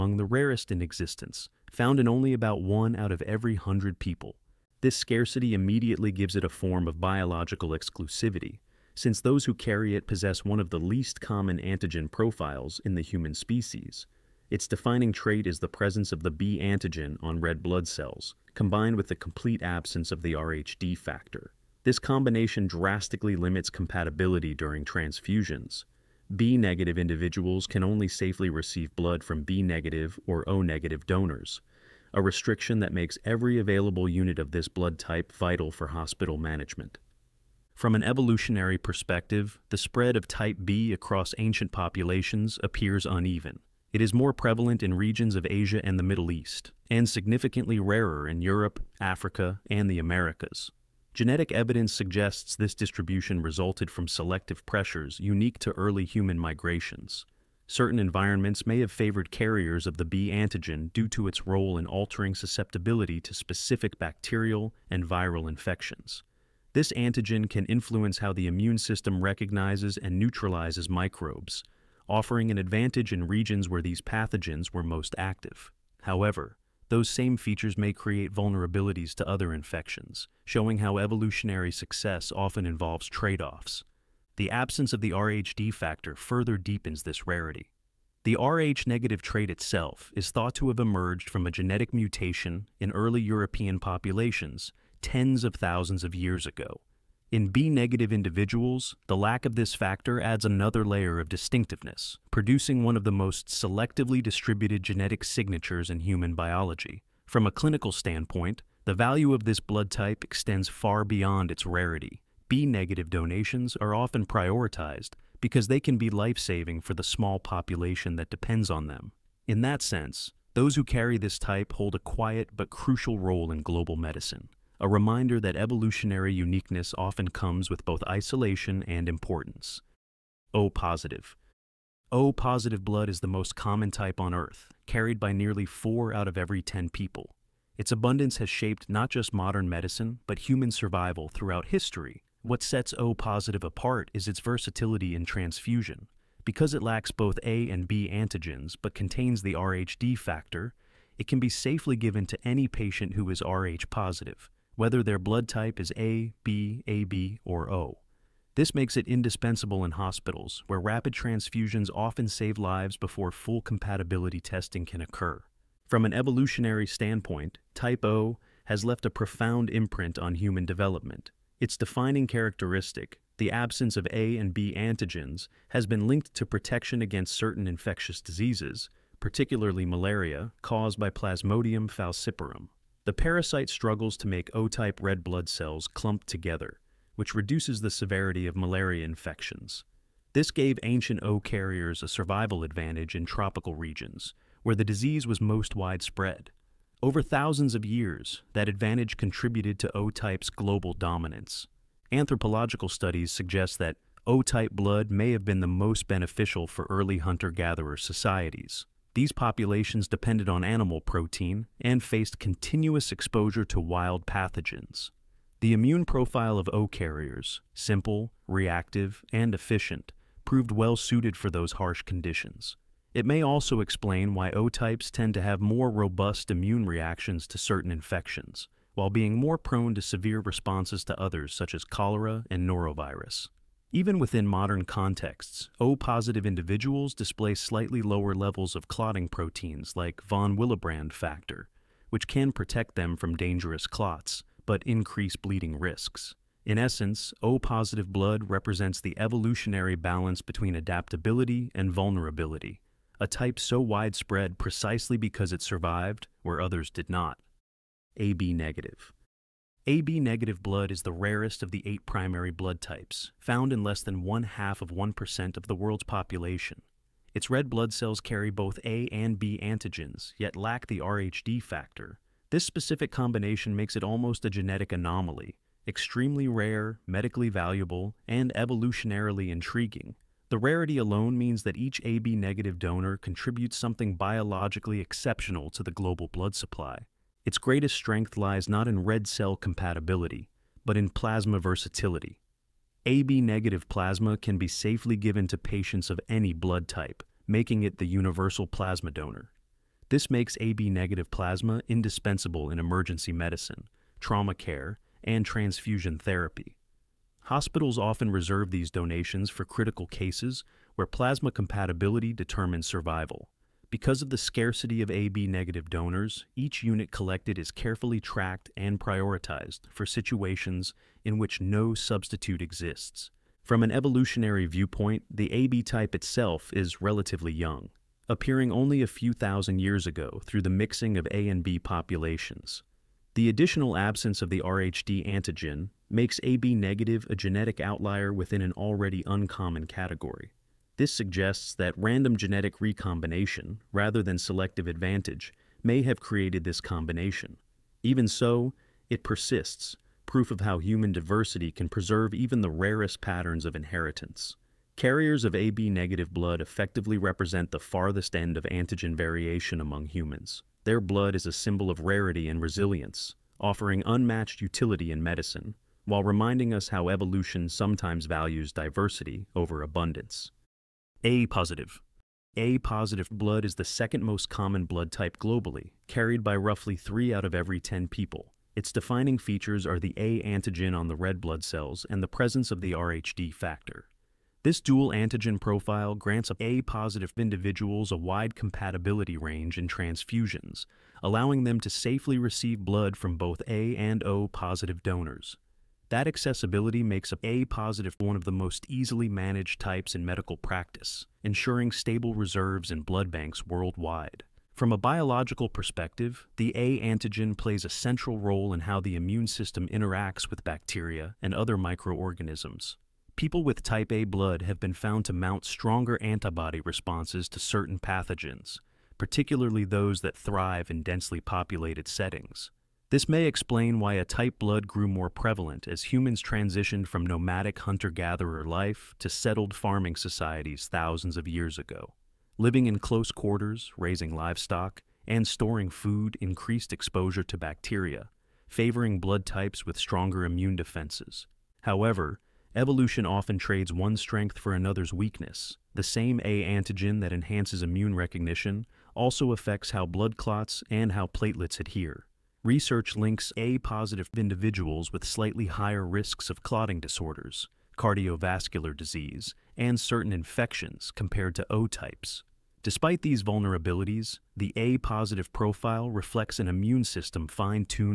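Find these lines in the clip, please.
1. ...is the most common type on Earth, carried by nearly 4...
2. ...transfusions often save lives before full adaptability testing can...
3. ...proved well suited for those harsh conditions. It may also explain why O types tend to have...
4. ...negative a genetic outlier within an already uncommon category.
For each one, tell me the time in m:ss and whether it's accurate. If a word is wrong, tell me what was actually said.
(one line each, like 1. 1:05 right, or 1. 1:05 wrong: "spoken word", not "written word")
1. 2:13 right
2. 2:41 wrong: "compatibility", not "adaptability"
3. 3:40 right
4. 5:36 right.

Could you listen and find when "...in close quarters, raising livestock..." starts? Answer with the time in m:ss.
7:12.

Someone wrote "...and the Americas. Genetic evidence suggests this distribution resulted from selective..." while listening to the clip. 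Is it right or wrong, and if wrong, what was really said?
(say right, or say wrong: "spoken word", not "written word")
right.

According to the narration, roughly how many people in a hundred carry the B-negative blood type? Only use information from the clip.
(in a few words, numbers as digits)
1.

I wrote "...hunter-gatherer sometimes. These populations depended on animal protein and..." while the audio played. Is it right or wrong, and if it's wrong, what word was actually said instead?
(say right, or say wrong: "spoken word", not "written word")
wrong: "societies", not "sometimes".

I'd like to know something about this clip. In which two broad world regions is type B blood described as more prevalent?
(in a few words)
Asia and the Middle East.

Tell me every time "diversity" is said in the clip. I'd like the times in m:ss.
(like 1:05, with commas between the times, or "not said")
5:51, 6:08.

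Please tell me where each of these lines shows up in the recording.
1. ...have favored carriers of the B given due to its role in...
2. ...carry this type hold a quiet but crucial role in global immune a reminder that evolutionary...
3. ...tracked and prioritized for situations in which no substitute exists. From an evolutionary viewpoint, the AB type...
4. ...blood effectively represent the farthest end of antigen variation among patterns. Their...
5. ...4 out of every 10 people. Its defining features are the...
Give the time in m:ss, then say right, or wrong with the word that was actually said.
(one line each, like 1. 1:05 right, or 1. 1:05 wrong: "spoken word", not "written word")
1. 0:58 wrong: "antigen", not "given"
2. 2:00 wrong: "medicine", not "immune"
3. 5:18 right
4. 5:56 wrong: "humans", not "patterns"
5. 6:16 wrong: "3", not "4".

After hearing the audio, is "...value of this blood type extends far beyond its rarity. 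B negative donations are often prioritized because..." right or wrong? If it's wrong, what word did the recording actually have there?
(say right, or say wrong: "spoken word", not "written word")
right.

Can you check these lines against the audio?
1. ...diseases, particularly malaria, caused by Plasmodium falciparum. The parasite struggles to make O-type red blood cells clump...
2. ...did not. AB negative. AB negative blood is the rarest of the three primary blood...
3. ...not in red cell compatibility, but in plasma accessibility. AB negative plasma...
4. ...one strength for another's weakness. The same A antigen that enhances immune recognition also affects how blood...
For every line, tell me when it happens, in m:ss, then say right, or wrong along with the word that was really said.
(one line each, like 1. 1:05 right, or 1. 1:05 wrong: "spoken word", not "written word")
1. 2:58 right
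2. 4:16 wrong: "eight", not "three"
3. 4:48 wrong: "versatility", not "accessibility"
4. 7:23 right.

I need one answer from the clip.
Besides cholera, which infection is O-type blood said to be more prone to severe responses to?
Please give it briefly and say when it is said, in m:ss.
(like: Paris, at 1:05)
Norovirus, at 3:52.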